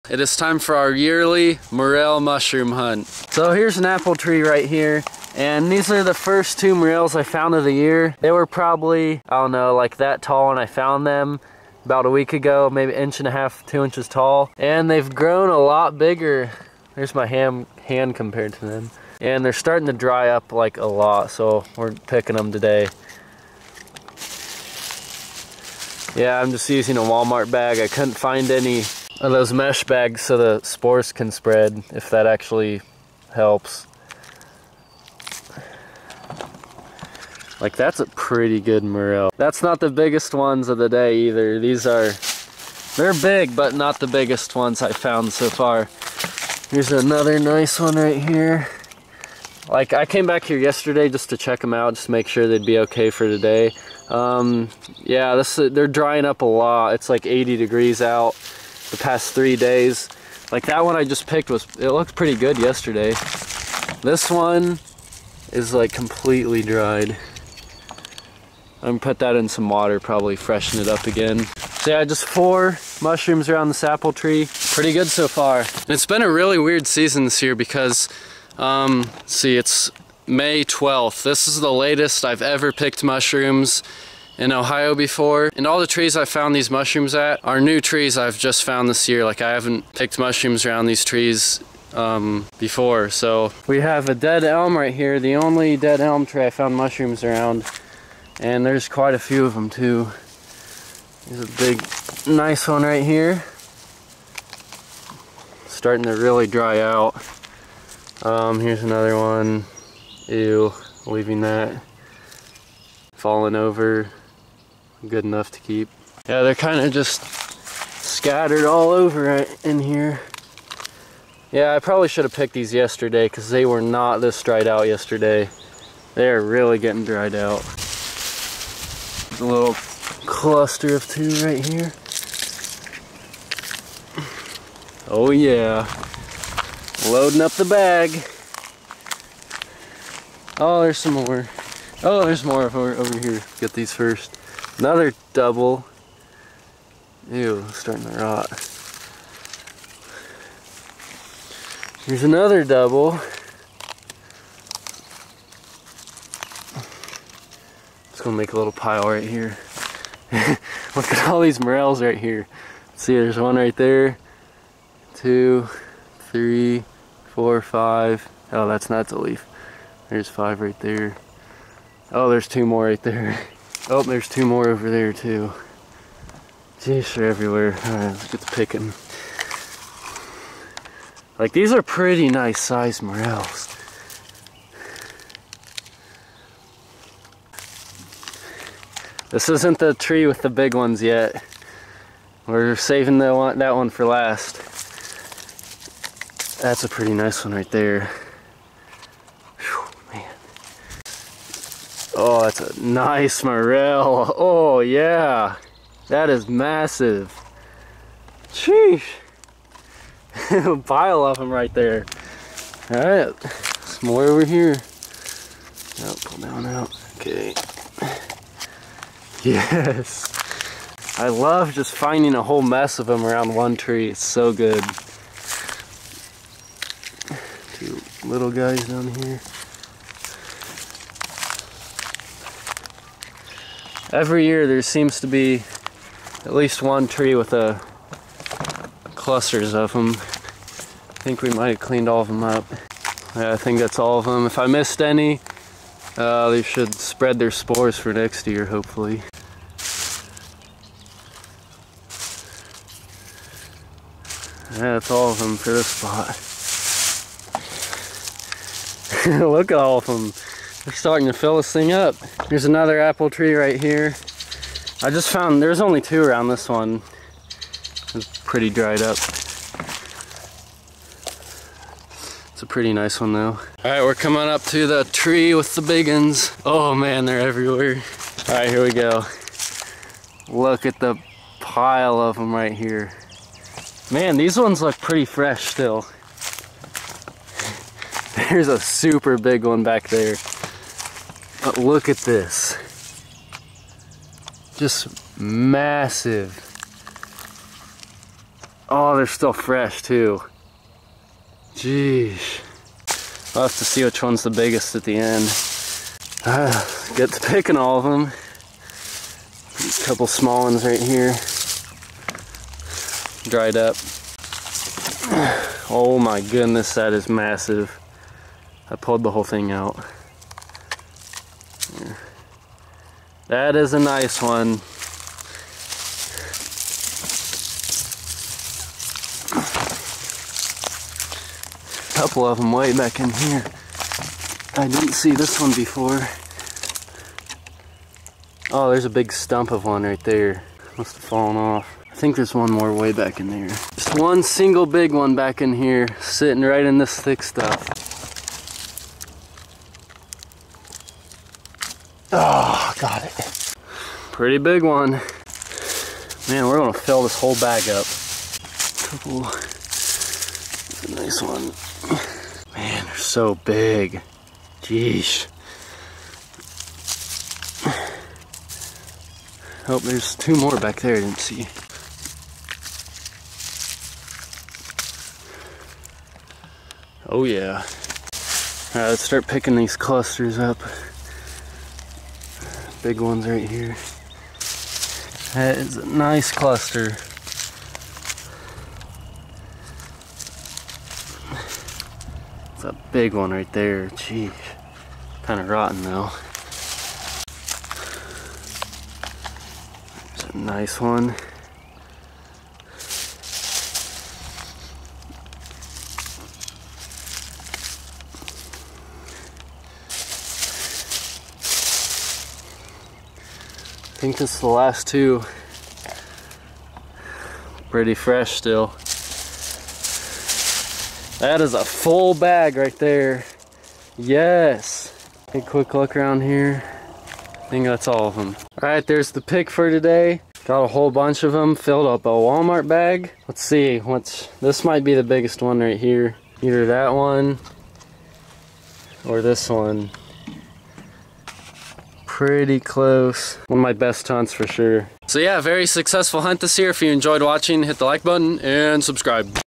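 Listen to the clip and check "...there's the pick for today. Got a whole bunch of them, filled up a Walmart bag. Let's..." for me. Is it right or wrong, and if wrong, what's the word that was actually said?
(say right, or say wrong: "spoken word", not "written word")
right.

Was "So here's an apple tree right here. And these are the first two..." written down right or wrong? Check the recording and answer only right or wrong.
right.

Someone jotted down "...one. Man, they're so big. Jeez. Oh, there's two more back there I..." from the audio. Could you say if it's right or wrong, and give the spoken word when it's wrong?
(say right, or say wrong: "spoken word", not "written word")
right.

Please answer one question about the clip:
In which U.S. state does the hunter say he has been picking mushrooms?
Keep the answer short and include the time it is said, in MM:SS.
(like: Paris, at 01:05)
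Ohio, at 01:24.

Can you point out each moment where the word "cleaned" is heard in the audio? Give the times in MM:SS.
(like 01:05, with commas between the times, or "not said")
04:01.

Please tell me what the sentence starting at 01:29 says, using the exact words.
Like I haven't picked mushrooms around these trees um, before.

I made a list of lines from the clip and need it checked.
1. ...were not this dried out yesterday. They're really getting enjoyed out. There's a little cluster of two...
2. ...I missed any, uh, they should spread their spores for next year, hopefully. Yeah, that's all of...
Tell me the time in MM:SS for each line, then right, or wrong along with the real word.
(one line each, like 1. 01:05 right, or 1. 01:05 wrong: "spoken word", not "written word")
1. 02:03 wrong: "dried", not "enjoyed"
2. 04:04 right.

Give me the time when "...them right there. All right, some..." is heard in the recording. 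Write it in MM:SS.
03:31.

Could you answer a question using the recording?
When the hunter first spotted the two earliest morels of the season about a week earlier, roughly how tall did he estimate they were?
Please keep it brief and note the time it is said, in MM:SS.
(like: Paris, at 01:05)
1.5 to 2 inches, at 00:12.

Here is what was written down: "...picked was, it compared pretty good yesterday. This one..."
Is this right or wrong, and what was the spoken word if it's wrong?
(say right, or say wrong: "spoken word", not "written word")
wrong: "looked", not "compared".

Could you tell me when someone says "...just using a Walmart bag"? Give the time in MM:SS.
00:26.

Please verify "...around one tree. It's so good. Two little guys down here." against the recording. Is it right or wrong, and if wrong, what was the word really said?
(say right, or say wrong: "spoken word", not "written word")
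right.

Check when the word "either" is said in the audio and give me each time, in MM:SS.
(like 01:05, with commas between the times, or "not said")
00:41, 07:16.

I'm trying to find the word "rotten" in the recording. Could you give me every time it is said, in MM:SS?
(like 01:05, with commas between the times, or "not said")
06:35.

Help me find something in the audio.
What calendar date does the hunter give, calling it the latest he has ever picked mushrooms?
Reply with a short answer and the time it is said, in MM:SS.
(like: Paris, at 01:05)
May 12th, at 01:20.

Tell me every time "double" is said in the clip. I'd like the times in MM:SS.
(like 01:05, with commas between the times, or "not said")
02:25, 02:32.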